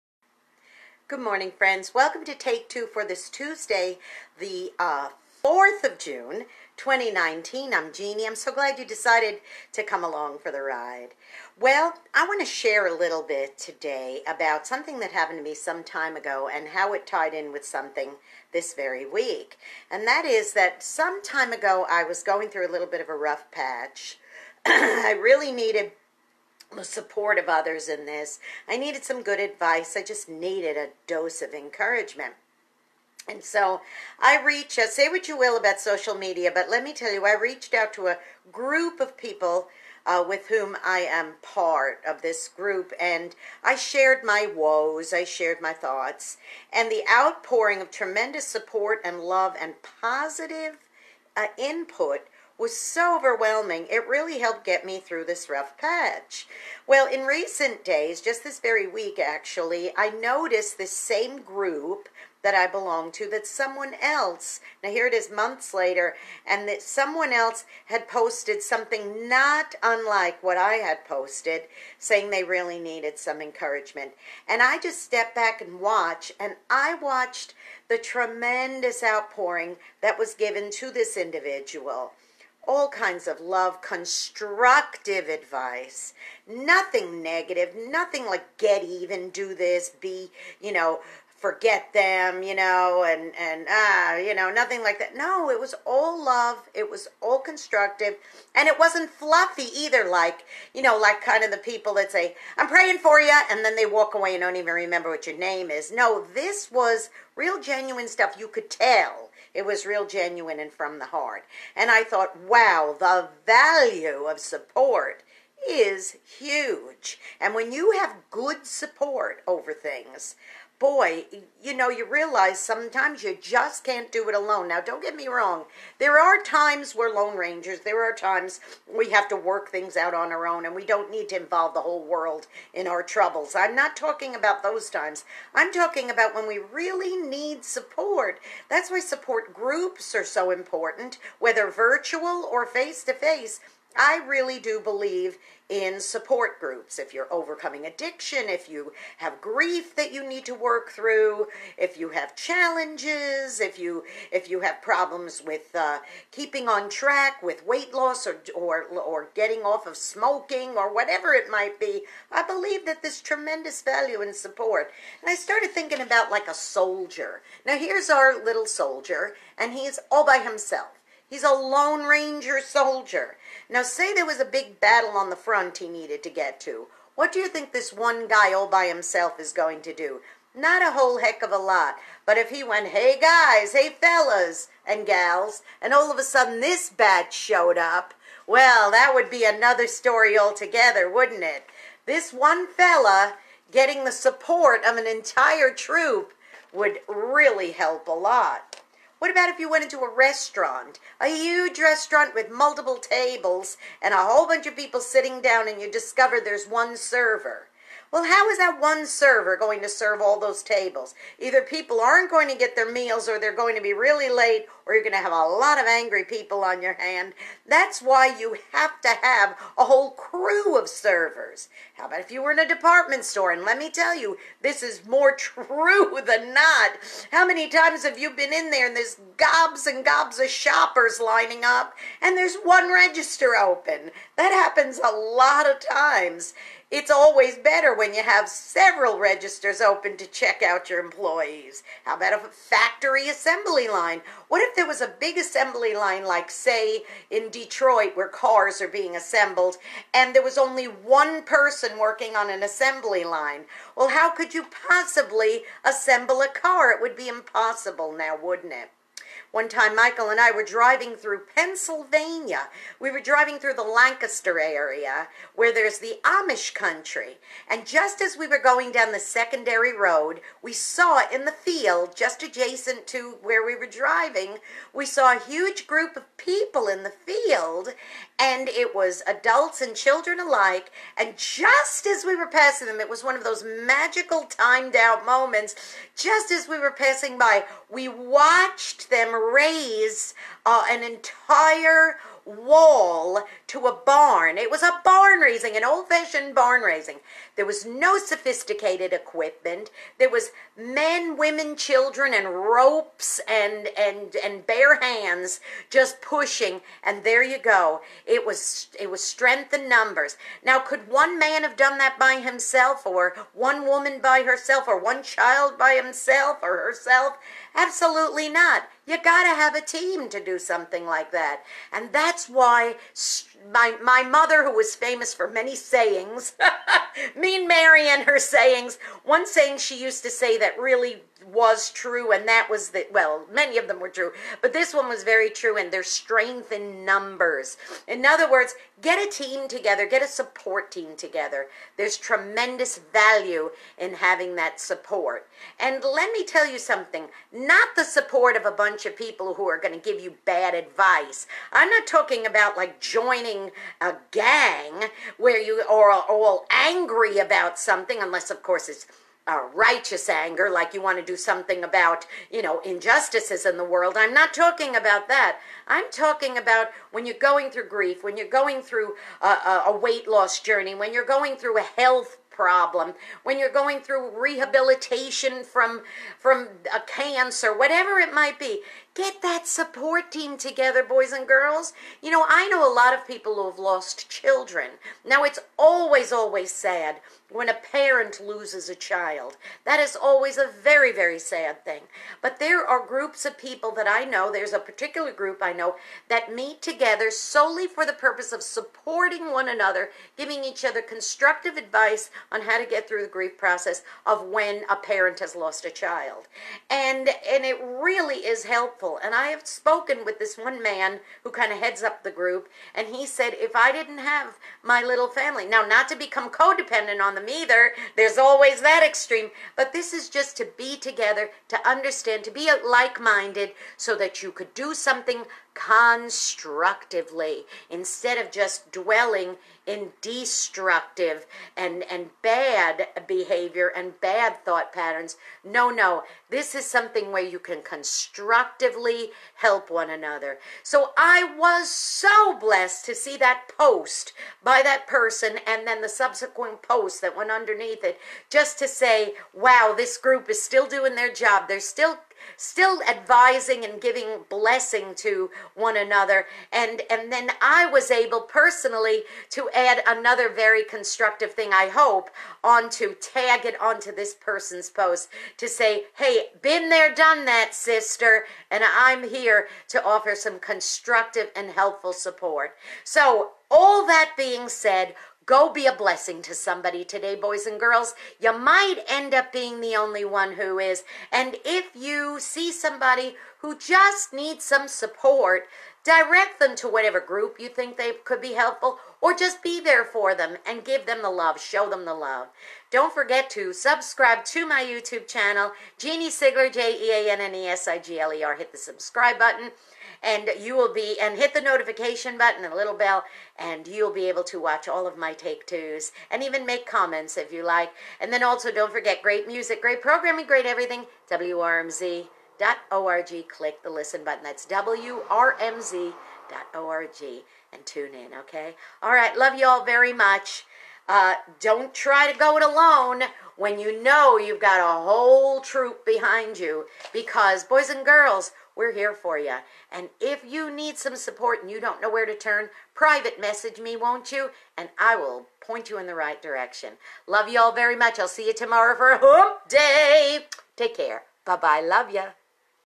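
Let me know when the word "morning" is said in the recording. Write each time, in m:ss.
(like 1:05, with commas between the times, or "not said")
0:01.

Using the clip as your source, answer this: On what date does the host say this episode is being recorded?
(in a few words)
June 4, 2019.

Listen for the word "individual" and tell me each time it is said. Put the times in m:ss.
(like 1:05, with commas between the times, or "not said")
1:21.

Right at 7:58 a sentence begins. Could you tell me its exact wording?
You might end up being the only one who is.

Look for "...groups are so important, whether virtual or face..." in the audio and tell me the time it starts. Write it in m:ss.
2:19.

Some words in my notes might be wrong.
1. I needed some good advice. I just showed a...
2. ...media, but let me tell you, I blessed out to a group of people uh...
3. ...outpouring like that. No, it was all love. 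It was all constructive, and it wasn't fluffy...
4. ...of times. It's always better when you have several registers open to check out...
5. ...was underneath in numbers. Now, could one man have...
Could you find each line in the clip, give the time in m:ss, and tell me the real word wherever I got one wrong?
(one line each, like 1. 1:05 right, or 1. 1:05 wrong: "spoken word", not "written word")
1. 0:28 wrong: "needed", not "showed"
2. 0:36 wrong: "reached", not "blessed"
3. 1:34 wrong: "nothing", not "outpouring"
4. 3:55 right
5. 5:09 wrong: "strength", not "underneath".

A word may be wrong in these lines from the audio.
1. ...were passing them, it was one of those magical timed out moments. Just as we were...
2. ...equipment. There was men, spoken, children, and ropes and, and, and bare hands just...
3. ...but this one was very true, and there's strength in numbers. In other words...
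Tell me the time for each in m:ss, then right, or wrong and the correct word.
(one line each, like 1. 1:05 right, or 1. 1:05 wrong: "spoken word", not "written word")
1. 4:42 right
2. 4:59 wrong: "women", not "spoken"
3. 5:34 right.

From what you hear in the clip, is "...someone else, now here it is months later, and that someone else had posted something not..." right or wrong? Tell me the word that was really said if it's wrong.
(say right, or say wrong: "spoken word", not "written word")
right.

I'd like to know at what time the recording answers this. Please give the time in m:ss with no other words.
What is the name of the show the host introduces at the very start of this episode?
0:02.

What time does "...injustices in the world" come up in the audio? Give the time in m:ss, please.
6:02.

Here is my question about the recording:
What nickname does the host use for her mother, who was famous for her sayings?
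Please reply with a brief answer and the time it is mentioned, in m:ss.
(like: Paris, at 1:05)
Mean Mary, at 5:27.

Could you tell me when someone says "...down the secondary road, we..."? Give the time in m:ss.
4:28.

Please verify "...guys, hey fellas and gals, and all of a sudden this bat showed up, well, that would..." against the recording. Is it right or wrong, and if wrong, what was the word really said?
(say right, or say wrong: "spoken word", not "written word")
right.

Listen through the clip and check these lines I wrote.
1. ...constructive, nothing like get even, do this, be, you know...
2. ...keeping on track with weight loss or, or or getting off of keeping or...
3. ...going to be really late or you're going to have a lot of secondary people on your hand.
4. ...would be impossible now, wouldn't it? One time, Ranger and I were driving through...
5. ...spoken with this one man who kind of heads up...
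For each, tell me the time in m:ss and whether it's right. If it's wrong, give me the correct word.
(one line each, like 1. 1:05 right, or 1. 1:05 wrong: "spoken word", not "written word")
1. 1:27 wrong: "negative", not "constructive"
2. 2:36 wrong: "smoking", not "keeping"
3. 3:33 wrong: "angry", not "secondary"
4. 4:16 wrong: "Michael", not "Ranger"
5. 6:49 right.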